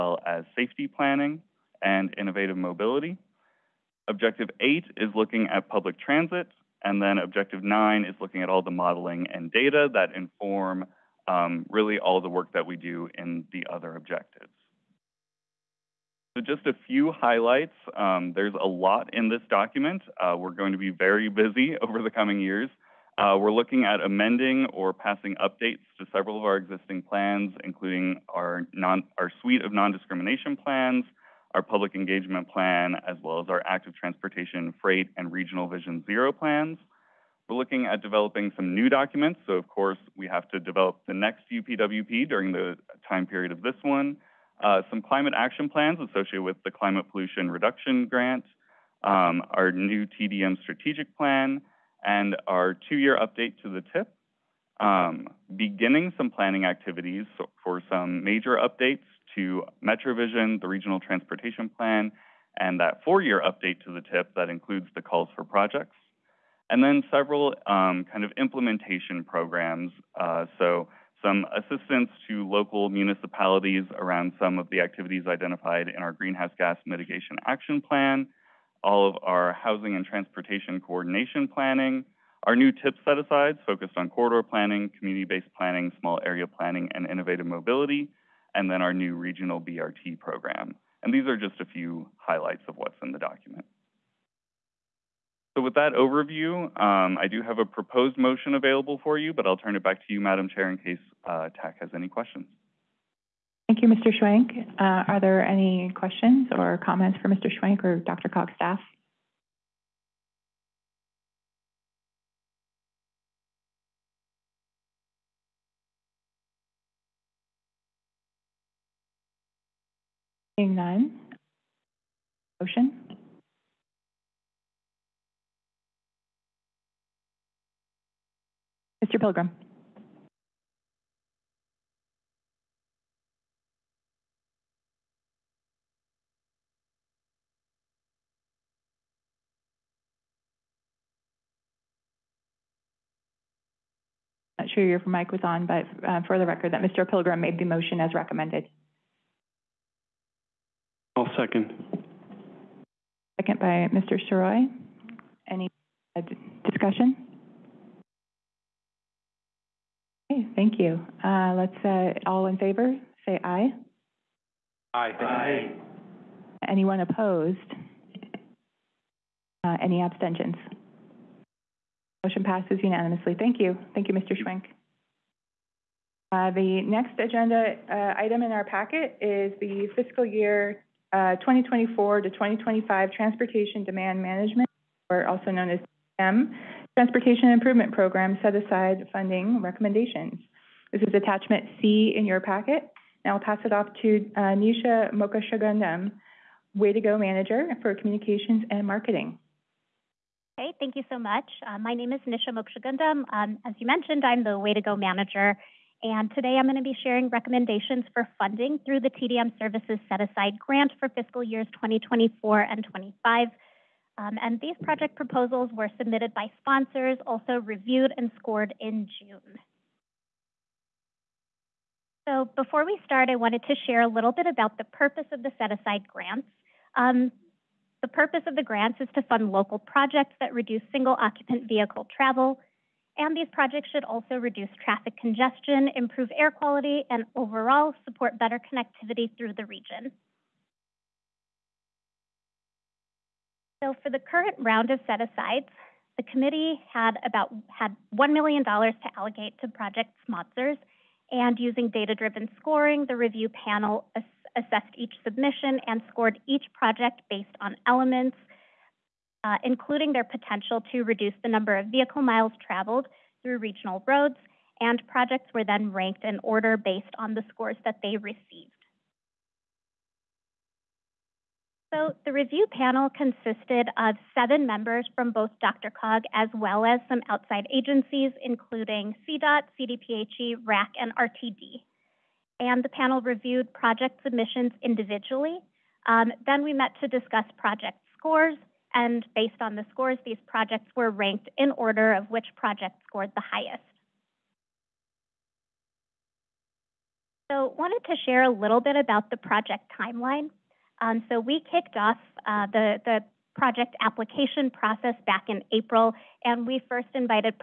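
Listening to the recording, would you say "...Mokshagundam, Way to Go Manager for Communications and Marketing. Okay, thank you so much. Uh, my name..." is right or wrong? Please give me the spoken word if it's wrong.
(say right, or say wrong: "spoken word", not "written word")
right.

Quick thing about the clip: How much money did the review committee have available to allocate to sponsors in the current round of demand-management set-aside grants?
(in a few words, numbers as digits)
$1 million.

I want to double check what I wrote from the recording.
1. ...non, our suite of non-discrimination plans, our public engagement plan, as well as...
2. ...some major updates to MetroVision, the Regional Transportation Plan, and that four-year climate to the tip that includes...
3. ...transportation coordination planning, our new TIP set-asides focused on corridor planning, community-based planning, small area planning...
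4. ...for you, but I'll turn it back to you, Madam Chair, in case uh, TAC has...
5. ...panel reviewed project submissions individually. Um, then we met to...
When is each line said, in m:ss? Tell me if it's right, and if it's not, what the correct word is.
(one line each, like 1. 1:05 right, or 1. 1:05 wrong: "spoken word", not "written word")
1. 0:28 right
2. 0:57 wrong: "update", not "climate"
3. 1:20 right
4. 1:39 right
5. 4:42 right.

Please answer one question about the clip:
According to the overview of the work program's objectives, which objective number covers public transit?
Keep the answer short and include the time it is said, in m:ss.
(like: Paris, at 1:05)
8, at 0:04.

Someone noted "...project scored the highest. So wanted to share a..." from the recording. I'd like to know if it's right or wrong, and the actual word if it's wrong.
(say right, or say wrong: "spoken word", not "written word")
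right.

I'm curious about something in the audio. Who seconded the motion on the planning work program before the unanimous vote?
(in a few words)
Mr. Sirois.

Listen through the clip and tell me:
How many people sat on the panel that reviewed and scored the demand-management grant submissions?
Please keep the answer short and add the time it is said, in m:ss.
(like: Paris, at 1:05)
7, at 4:34.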